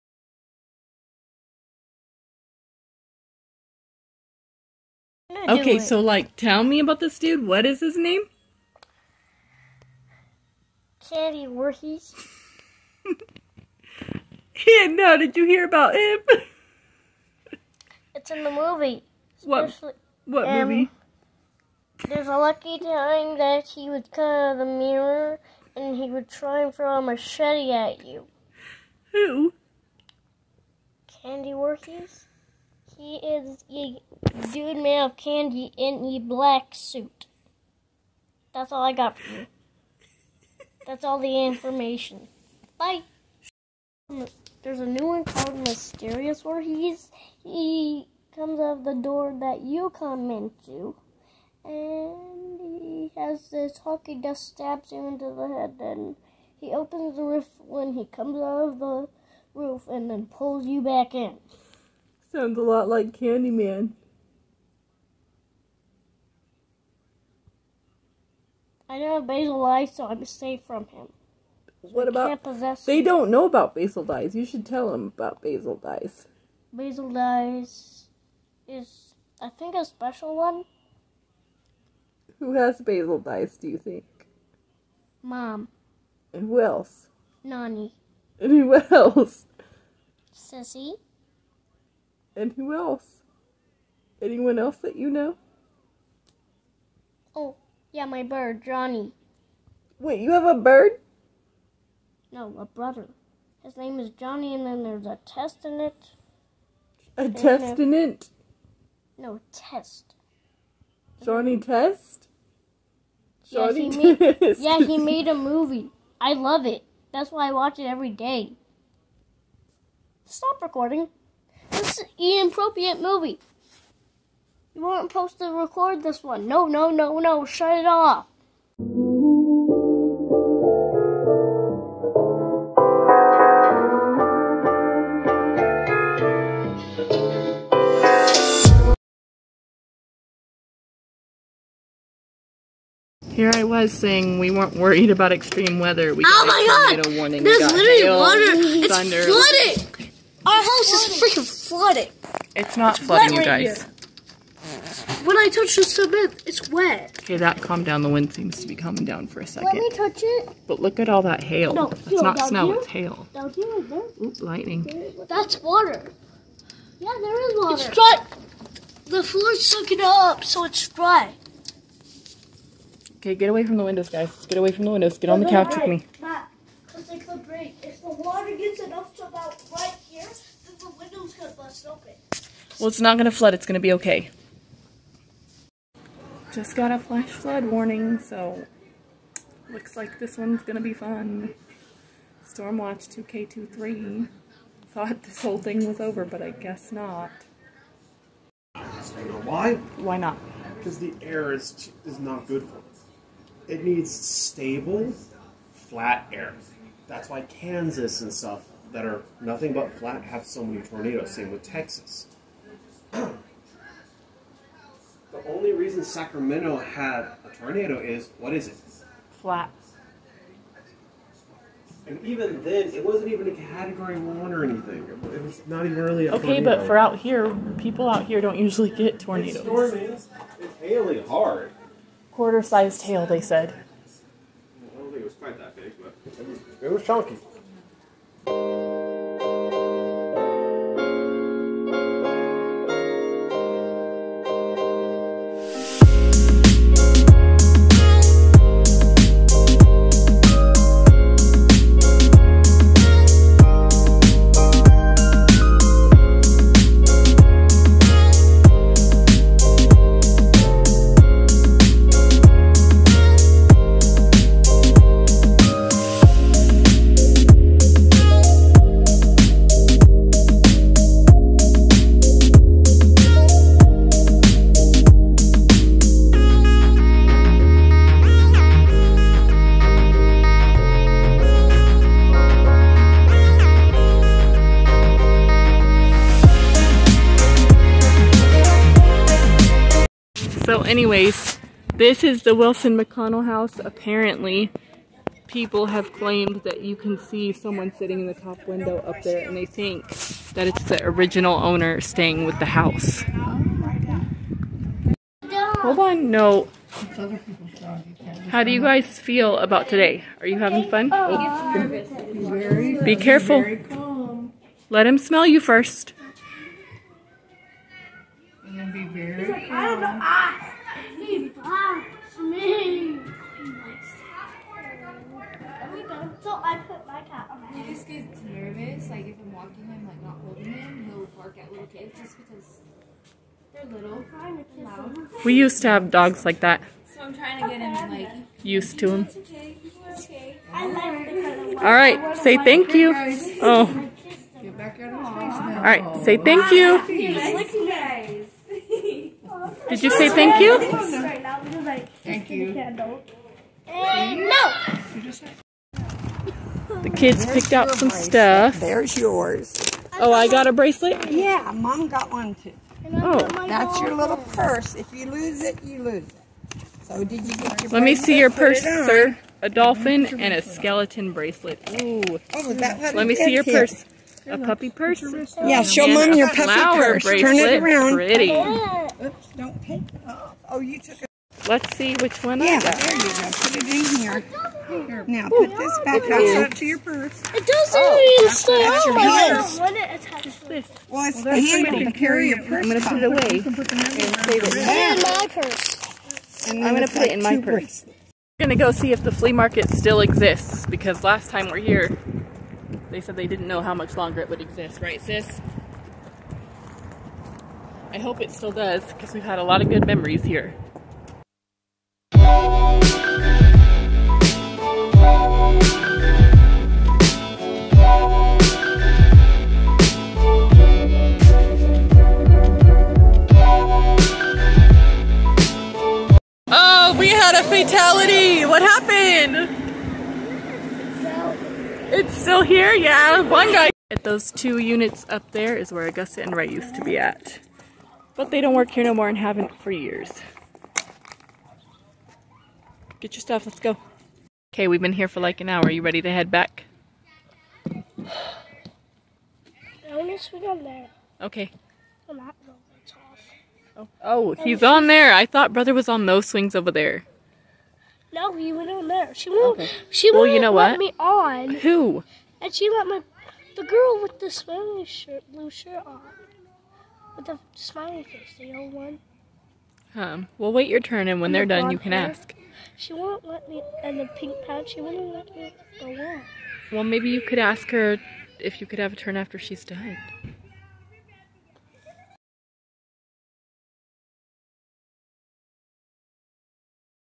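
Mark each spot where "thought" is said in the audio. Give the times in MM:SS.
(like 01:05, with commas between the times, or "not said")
03:14, 07:35.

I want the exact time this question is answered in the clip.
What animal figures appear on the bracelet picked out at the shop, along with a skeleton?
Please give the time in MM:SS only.
06:09.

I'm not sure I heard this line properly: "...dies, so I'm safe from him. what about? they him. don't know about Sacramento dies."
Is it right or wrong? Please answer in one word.
wrong.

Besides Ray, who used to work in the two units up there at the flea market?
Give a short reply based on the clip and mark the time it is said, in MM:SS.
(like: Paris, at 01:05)
Augusta, at 07:16.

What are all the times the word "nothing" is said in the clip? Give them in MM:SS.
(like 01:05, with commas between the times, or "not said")
03:29.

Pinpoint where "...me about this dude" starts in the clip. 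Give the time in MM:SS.
00:06.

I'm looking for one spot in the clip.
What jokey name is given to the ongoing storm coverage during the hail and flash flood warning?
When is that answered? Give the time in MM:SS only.
03:12.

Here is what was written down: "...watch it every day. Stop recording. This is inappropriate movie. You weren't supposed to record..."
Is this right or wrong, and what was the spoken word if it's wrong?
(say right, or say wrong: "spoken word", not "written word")
right.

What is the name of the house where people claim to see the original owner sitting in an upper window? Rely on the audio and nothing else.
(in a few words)
Wilson McConnell house.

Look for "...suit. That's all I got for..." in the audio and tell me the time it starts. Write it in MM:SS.
00:36.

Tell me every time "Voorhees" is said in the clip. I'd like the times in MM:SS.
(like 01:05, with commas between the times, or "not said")
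00:11, 00:31.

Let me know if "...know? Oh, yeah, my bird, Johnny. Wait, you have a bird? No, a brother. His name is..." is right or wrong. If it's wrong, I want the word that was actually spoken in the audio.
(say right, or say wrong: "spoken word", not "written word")
right.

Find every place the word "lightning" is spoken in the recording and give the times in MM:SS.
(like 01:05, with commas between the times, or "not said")
02:44.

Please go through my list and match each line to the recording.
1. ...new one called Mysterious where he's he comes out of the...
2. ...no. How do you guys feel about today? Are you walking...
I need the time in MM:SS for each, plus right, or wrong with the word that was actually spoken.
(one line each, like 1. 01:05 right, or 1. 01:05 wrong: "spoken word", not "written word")
1. 00:44 right
2. 05:06 wrong: "having", not "walking".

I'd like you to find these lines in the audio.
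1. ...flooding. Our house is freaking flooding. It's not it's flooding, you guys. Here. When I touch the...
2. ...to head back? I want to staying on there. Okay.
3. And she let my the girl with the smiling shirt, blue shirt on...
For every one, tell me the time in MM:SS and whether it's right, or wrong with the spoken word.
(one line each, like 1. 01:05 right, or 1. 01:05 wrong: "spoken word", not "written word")
1. 02:29 right
2. 07:26 wrong: "swing", not "staying"
3. 07:42 right.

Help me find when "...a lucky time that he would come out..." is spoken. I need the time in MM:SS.
00:22.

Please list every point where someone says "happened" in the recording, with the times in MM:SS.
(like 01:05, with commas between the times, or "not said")
07:08.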